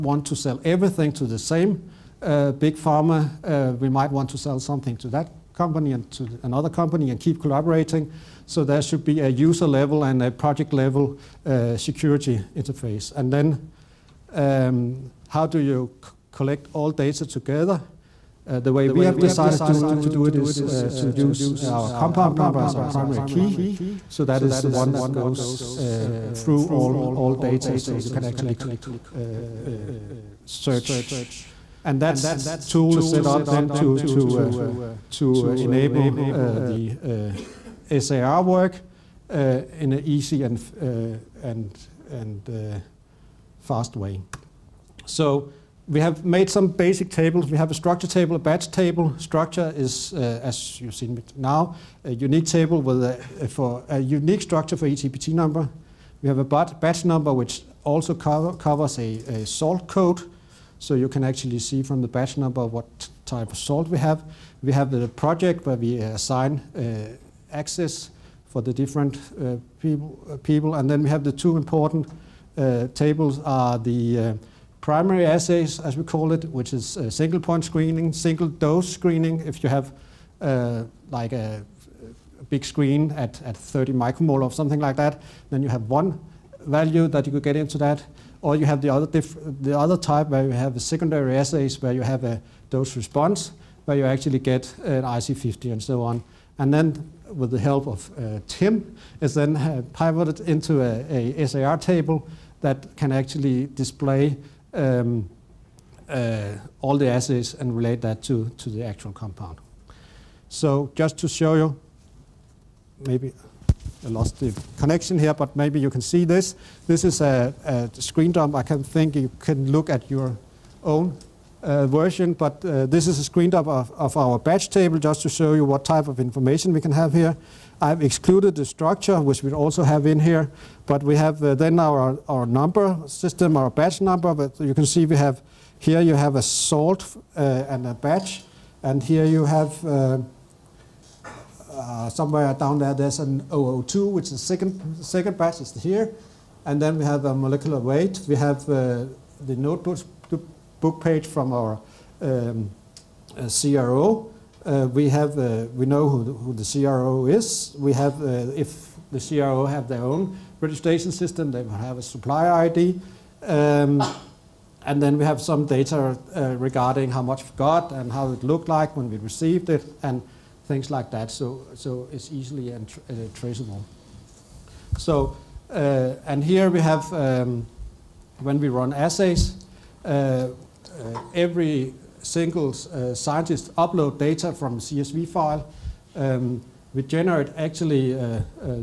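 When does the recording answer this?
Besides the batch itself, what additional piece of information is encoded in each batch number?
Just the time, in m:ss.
0:59.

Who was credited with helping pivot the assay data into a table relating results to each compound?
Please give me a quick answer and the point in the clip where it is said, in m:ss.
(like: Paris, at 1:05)
Tim, at 1:38.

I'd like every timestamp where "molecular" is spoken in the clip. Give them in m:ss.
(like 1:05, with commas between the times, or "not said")
2:27.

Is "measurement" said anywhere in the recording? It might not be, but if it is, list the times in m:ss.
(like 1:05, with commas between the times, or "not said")
not said.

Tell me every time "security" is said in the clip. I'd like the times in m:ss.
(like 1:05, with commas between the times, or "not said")
0:11.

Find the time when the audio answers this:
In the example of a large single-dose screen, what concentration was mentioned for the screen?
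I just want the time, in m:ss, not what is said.
1:23.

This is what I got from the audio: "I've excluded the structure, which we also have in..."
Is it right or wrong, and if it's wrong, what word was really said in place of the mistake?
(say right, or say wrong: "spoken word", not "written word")
right.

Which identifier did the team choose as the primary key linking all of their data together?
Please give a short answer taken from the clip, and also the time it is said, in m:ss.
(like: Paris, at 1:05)
compound number, at 0:21.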